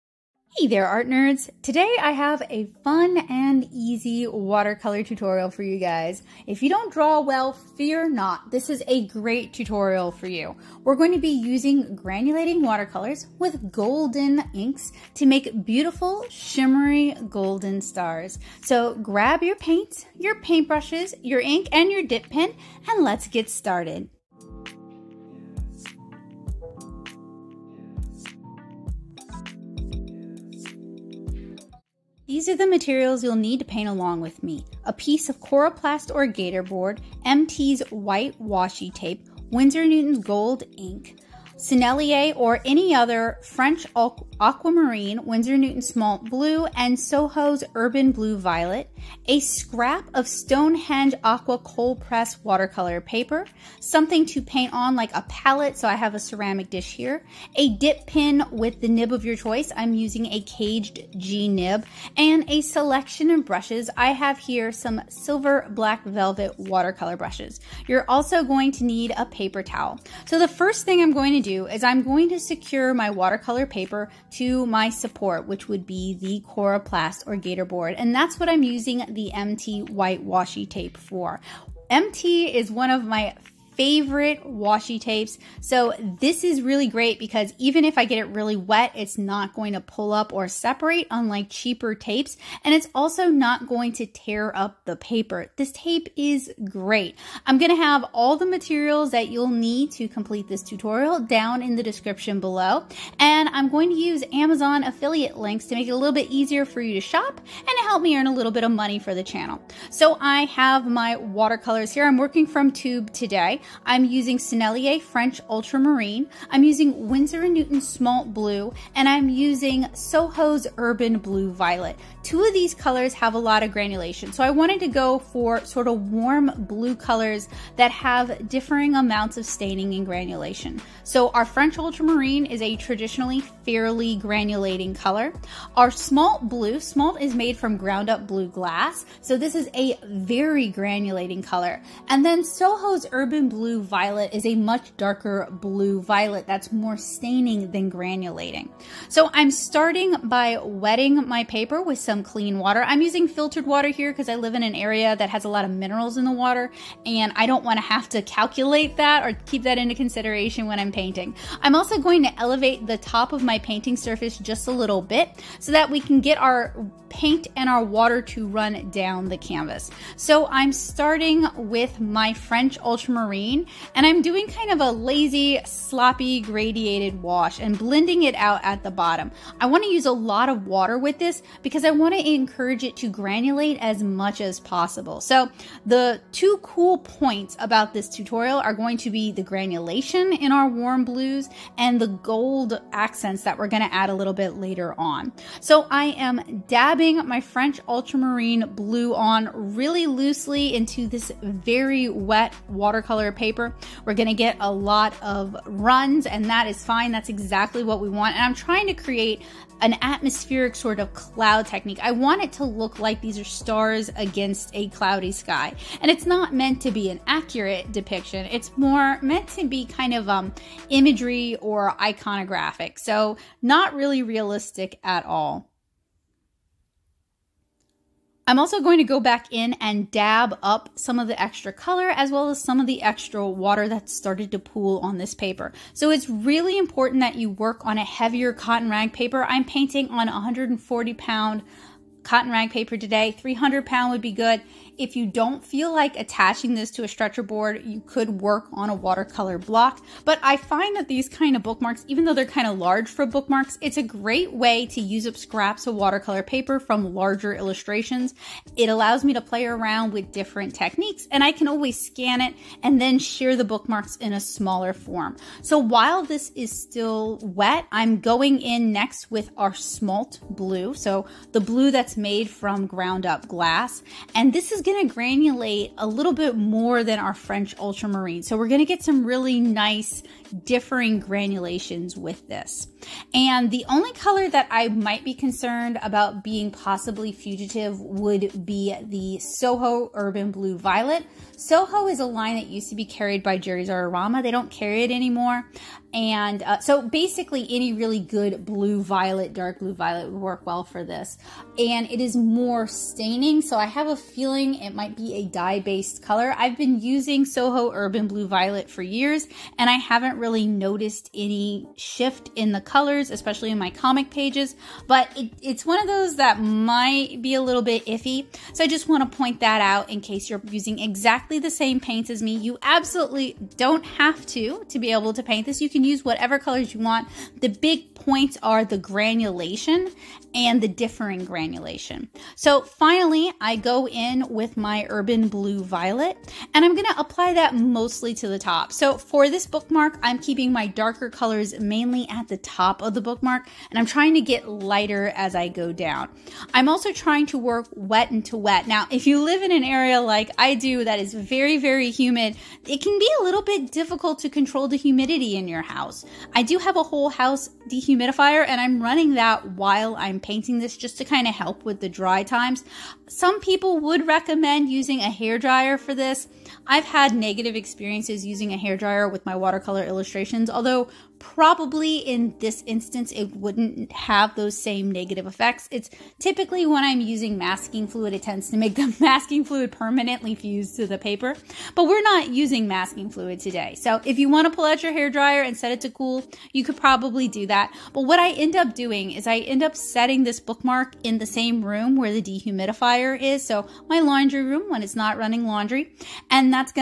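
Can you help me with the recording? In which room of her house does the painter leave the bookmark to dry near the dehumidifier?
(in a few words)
laundry room.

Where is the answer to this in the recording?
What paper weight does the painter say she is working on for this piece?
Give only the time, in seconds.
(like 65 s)
240 s.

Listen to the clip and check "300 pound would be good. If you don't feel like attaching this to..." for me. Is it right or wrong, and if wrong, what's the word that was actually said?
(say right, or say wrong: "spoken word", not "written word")
right.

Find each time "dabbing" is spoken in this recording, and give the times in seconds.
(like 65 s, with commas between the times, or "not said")
196 s.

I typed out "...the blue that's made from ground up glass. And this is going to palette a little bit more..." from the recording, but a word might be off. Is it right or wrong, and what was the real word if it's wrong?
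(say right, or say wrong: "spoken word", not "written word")
wrong: "granulate", not "palette".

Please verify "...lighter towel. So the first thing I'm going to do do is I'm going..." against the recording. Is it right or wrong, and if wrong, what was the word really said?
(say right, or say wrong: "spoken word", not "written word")
wrong: "paper", not "lighter".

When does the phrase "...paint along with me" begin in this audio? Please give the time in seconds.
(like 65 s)
33 s.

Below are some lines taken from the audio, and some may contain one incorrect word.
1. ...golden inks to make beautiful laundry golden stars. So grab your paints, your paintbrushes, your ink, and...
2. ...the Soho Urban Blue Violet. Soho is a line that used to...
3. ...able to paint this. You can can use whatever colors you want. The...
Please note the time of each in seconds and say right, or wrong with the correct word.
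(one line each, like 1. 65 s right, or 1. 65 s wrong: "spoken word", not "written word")
1. 13 s wrong: "shimmery", not "laundry"
2. 289 s right
3. 325 s right.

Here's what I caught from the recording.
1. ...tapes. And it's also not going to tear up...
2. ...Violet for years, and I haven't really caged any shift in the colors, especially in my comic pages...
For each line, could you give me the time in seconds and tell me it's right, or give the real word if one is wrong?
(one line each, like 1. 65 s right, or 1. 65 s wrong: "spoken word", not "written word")
1. 91 s right
2. 308 s wrong: "noticed", not "caged".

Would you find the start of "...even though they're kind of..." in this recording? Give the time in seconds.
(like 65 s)
252 s.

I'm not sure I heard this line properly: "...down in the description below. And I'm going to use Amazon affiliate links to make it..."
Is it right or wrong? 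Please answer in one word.
right.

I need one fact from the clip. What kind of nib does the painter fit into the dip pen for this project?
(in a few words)
caged G nib.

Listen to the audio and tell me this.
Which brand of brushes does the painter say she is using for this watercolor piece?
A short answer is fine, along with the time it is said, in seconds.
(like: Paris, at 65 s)
silver black velvet, at 65 s.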